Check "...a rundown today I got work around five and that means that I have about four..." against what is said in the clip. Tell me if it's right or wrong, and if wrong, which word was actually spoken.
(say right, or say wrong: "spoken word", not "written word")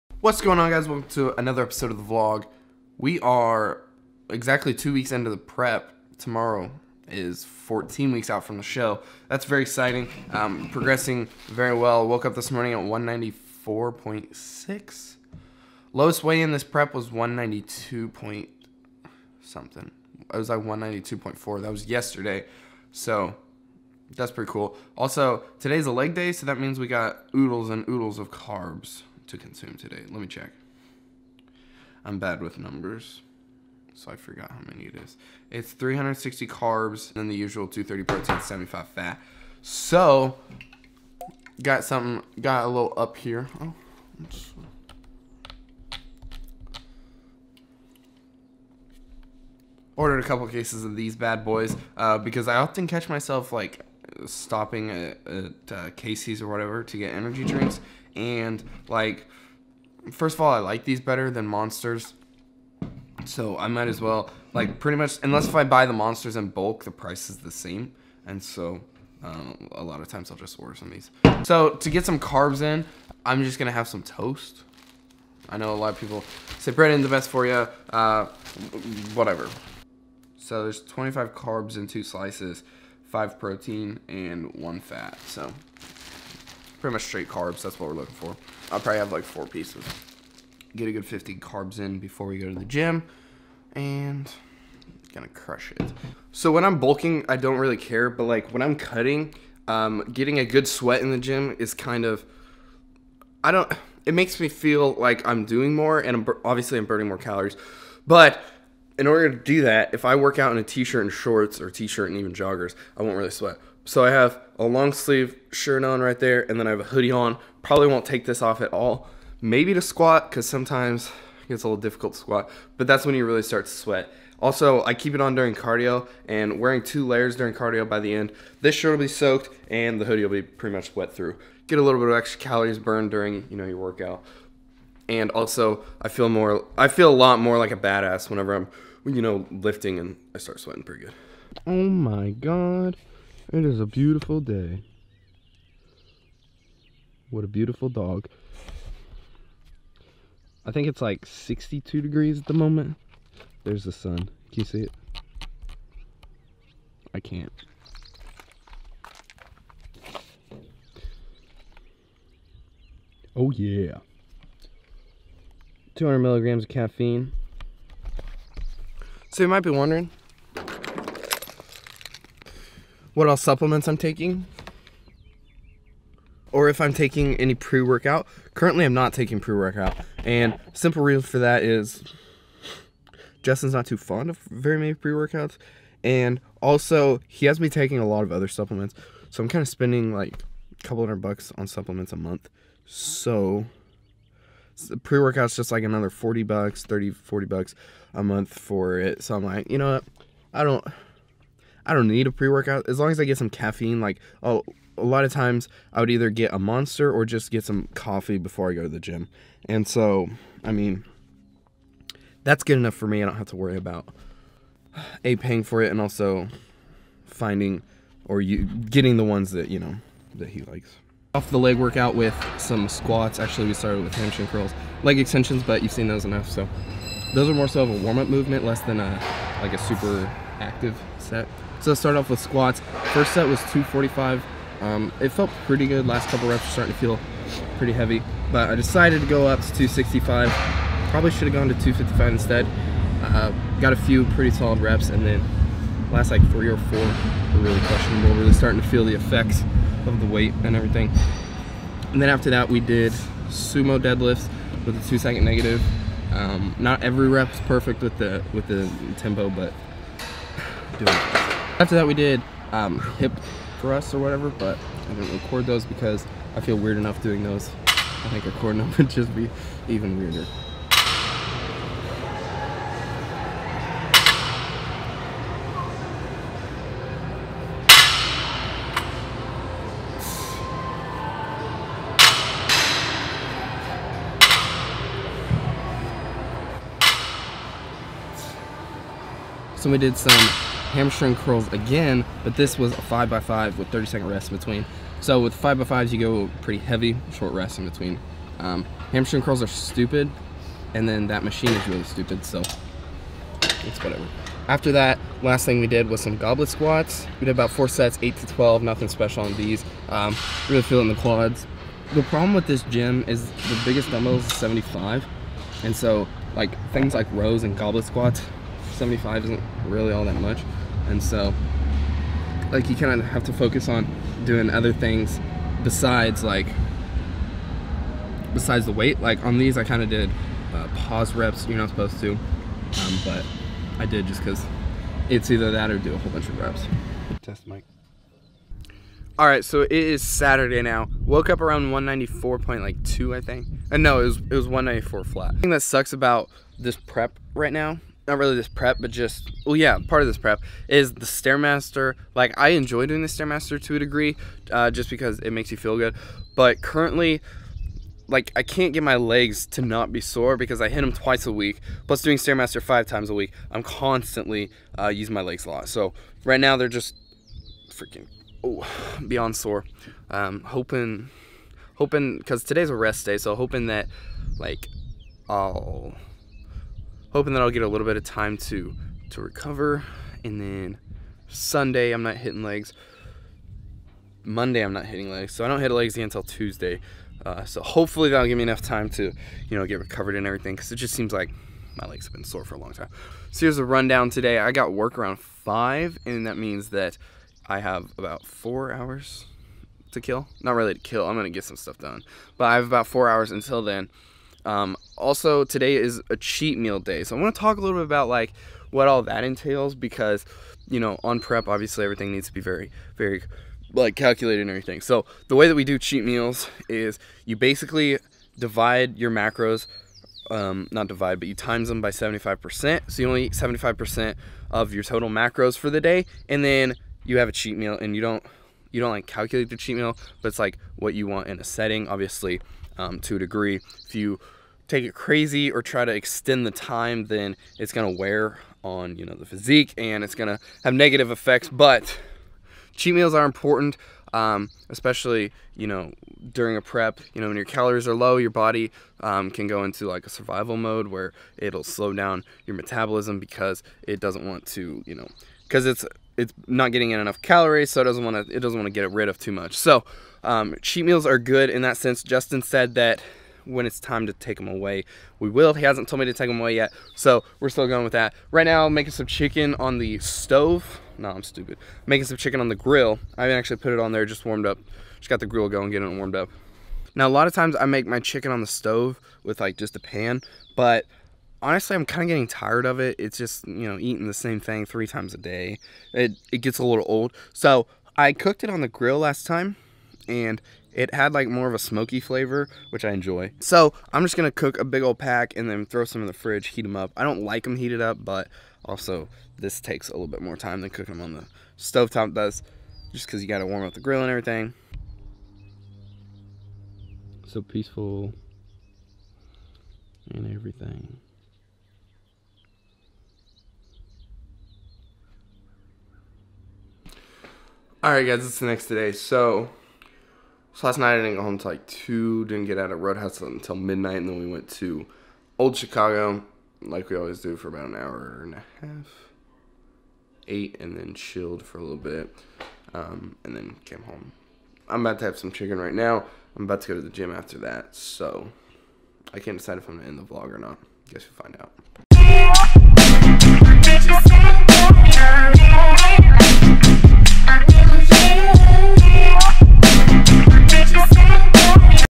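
right.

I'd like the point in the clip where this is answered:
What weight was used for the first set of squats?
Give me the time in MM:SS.
03:53.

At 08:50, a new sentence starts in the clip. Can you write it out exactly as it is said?
Ate and then chilled for a little bit, um, and then came home.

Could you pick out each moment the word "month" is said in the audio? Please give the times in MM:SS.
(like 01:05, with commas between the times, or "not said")
03:12, 03:18.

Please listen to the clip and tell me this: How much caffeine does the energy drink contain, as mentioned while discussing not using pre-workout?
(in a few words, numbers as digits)
200 milligrams.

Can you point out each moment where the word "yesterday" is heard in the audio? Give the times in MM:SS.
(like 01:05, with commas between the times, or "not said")
00:21.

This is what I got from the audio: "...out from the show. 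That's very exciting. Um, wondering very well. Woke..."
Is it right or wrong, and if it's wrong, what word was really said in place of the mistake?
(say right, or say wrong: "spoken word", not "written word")
wrong: "progressing", not "wondering".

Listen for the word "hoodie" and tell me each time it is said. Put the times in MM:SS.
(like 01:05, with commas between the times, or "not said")
01:56, 02:10.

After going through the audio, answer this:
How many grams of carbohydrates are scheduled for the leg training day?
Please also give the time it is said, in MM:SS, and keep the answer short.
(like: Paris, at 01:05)
360, at 00:35.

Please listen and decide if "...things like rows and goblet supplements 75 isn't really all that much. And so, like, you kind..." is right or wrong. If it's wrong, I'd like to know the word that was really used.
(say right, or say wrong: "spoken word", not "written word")
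wrong: "squats", not "supplements".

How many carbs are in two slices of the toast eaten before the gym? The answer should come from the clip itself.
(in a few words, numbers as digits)
25.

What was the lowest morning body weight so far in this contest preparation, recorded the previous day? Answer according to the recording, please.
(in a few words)
192.4.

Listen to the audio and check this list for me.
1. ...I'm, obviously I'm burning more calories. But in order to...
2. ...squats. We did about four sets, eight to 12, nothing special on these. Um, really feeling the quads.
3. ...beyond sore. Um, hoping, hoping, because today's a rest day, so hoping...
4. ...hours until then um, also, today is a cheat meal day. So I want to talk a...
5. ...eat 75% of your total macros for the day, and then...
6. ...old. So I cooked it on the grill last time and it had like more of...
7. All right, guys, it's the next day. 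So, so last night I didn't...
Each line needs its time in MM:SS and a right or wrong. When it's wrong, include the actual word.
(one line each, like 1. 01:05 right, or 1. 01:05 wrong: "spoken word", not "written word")
1. 01:46 right
2. 05:06 right
3. 06:09 right
4. 06:43 right
5. 07:03 right
6. 08:07 right
7. 08:38 right.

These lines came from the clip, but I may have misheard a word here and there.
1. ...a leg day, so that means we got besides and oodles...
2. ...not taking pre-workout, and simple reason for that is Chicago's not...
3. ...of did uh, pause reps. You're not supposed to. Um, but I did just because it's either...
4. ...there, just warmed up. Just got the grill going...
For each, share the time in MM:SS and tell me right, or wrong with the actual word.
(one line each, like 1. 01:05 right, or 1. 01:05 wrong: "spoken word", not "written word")
1. 00:25 wrong: "oodles", not "besides"
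2. 02:58 wrong: "Justin", not "Chicago"
3. 05:30 right
4. 07:54 right.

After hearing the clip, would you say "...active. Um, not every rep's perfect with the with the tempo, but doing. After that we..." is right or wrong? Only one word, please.
wrong.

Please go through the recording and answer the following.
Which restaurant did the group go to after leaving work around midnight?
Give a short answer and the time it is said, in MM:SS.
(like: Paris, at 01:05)
Old Chicago, at 08:45.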